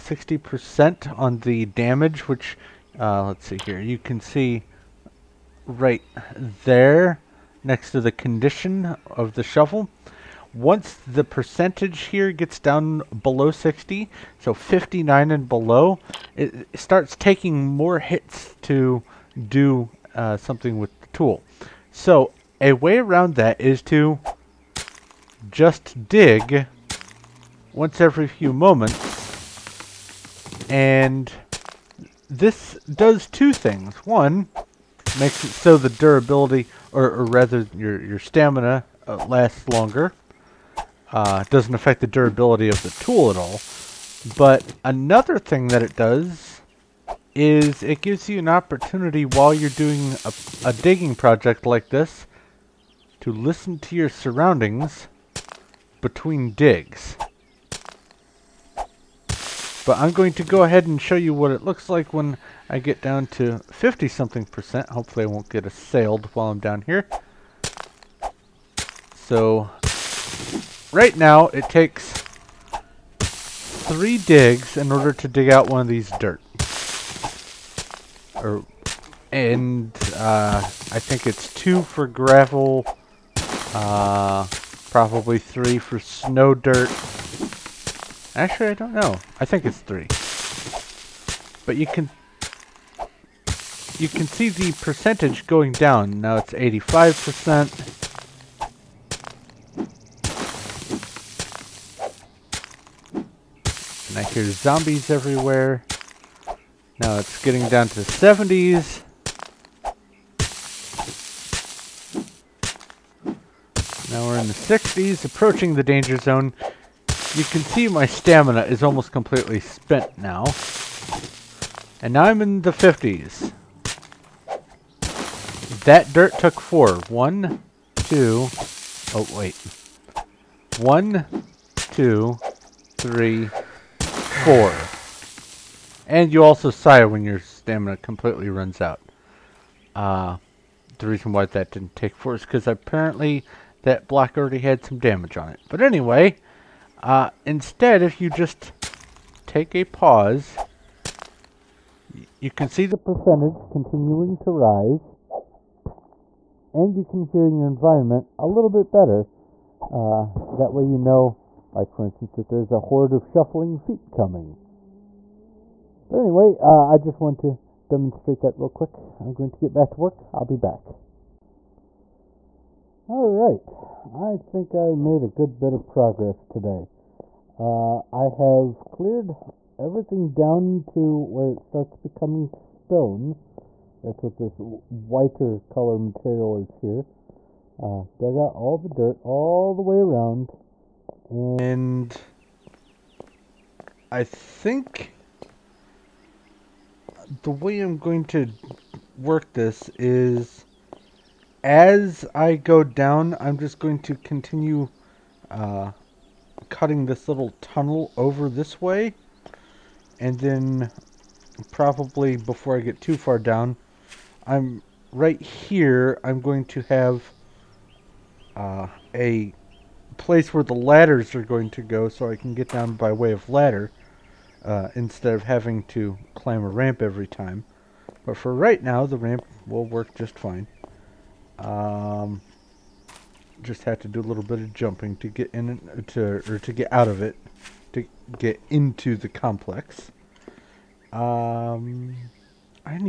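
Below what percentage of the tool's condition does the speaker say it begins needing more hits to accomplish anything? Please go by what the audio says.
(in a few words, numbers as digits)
60.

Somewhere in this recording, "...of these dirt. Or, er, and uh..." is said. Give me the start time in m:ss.
1:15.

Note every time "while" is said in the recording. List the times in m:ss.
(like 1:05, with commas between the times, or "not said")
0:49, 1:06.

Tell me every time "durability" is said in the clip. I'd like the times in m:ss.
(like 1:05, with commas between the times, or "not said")
0:35, 0:42.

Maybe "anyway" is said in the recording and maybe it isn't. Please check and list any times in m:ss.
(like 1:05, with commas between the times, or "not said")
2:25, 2:46.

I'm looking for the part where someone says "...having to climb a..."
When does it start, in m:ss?
3:45.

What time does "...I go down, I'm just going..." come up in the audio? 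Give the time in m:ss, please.
3:22.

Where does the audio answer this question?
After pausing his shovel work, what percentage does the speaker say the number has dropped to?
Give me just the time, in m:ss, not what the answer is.
1:36.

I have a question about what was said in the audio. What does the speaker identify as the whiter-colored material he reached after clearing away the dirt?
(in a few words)
stone.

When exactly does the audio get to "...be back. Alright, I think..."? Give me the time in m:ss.
2:50.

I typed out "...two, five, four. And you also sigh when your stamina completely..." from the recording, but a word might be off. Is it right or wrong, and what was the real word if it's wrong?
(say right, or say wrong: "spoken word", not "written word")
wrong: "three", not "five".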